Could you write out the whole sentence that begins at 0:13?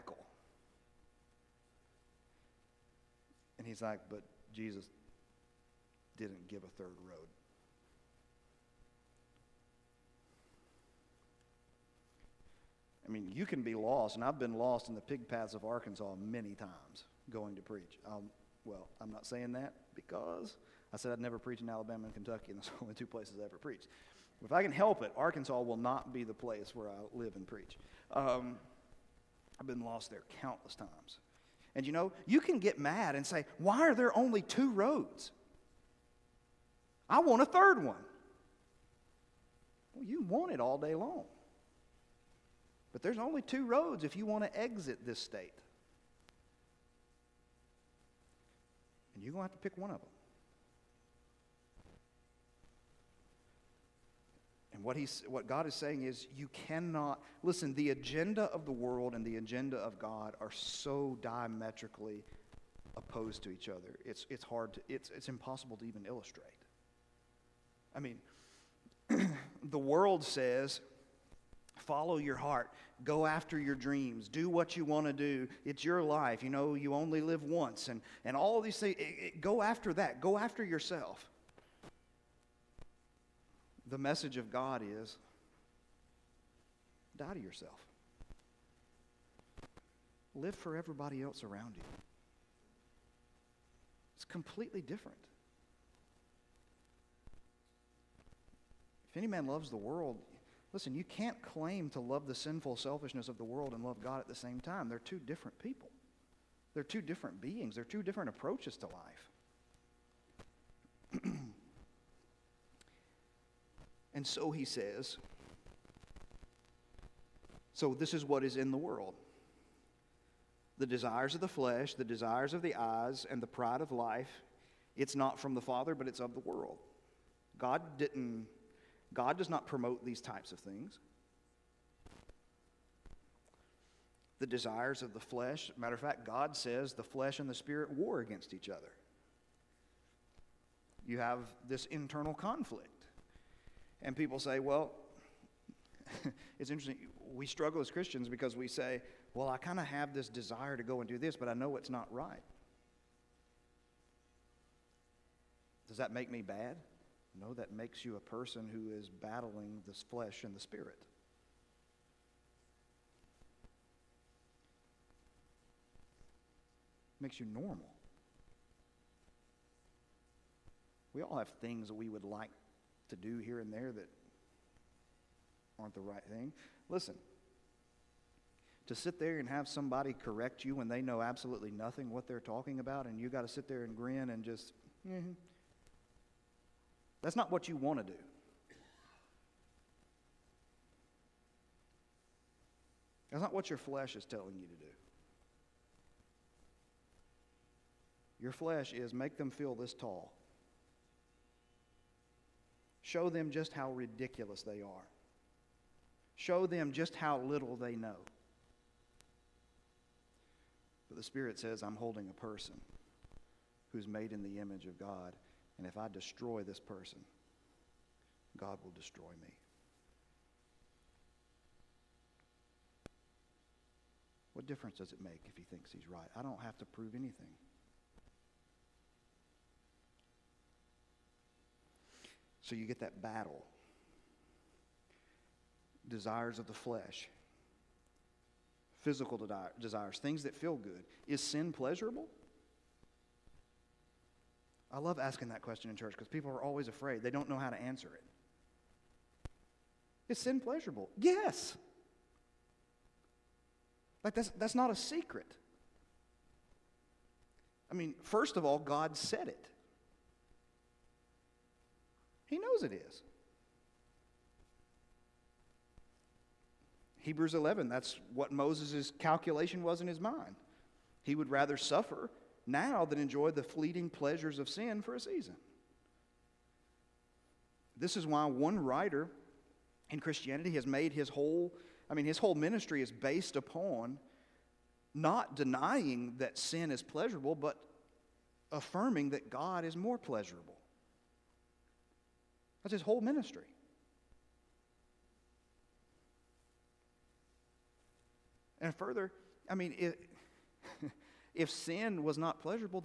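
I mean, you can be lost, and I've been lost in the pig paths of Arkansas many times going to preach.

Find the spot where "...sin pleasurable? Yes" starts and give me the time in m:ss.
4:10.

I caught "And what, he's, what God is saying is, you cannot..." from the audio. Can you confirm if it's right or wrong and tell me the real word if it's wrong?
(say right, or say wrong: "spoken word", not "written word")
right.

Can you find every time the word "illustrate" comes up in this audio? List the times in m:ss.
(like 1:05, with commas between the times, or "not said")
1:06.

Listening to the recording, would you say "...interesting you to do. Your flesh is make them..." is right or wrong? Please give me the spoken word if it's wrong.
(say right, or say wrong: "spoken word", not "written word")
wrong: "telling", not "interesting".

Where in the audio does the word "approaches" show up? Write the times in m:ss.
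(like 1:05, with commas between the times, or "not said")
1:48.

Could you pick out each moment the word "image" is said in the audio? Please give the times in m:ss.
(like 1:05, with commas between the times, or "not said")
3:34.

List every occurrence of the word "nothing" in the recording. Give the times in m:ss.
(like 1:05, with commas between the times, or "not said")
3:01.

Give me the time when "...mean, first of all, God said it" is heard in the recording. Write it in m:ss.
4:17.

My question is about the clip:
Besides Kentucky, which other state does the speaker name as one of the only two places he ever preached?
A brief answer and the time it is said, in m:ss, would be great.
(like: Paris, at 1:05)
Alabama, at 0:21.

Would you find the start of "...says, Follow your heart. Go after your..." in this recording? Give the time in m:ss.
1:10.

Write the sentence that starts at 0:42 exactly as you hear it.
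But there's only two roads if you want to exit this state.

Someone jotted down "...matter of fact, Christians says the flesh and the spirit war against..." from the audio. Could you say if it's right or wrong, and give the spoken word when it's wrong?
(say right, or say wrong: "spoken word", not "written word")
wrong: "God", not "Christians".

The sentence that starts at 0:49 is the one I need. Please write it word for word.
You're going to have to pick one of them.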